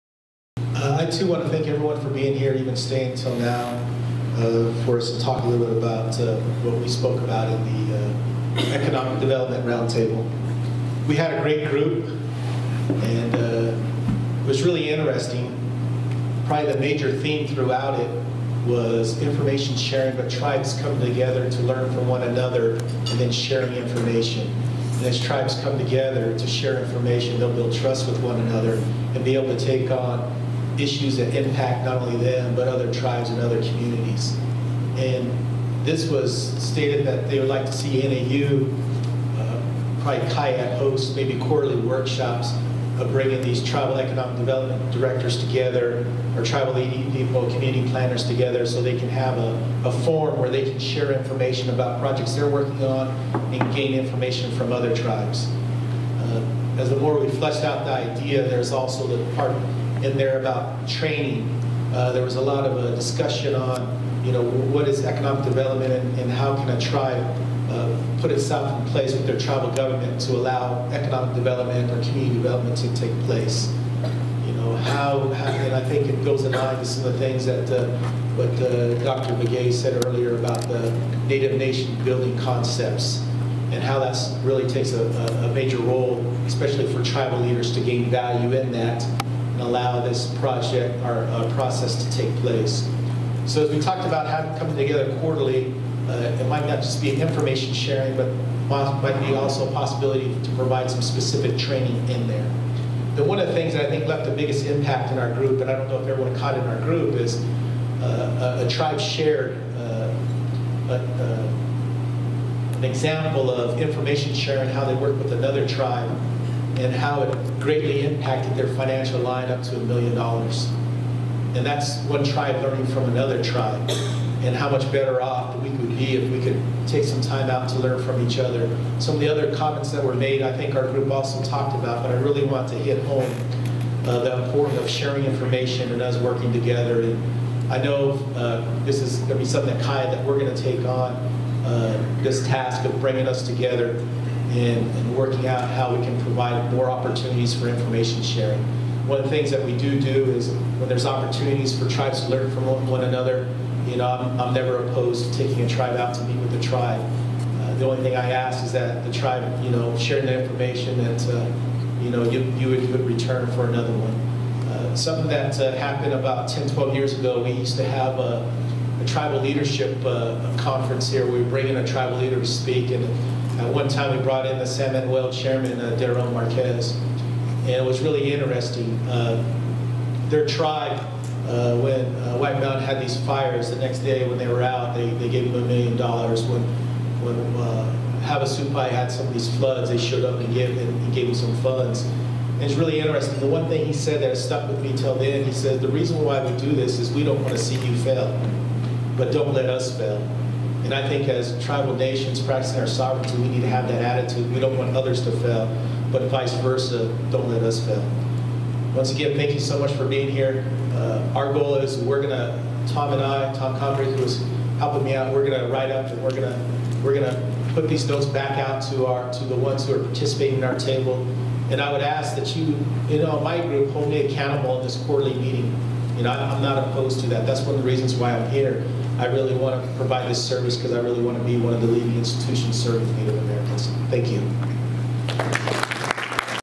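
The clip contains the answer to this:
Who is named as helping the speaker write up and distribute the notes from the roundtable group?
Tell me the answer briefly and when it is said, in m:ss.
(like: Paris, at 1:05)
Tom Condry, at 3:33.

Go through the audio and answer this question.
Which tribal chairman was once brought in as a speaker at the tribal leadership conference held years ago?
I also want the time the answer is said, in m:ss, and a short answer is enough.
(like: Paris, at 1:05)
Deron Marquez, at 2:55.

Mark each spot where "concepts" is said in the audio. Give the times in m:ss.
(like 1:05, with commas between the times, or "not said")
1:22.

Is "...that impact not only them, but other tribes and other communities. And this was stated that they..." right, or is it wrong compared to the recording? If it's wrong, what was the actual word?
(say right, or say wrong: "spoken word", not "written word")
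right.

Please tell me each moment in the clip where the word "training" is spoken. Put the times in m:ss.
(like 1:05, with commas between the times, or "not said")
1:00, 1:41.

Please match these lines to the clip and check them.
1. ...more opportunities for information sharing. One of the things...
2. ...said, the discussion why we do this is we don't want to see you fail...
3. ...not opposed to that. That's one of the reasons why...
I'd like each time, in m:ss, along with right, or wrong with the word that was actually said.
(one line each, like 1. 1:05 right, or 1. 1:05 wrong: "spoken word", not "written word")
1. 2:26 right
2. 3:15 wrong: "reason", not "discussion"
3. 3:46 right.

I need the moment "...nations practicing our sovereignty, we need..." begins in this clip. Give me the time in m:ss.
3:21.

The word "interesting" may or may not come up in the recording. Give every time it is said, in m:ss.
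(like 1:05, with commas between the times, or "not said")
0:14, 2:58, 3:12.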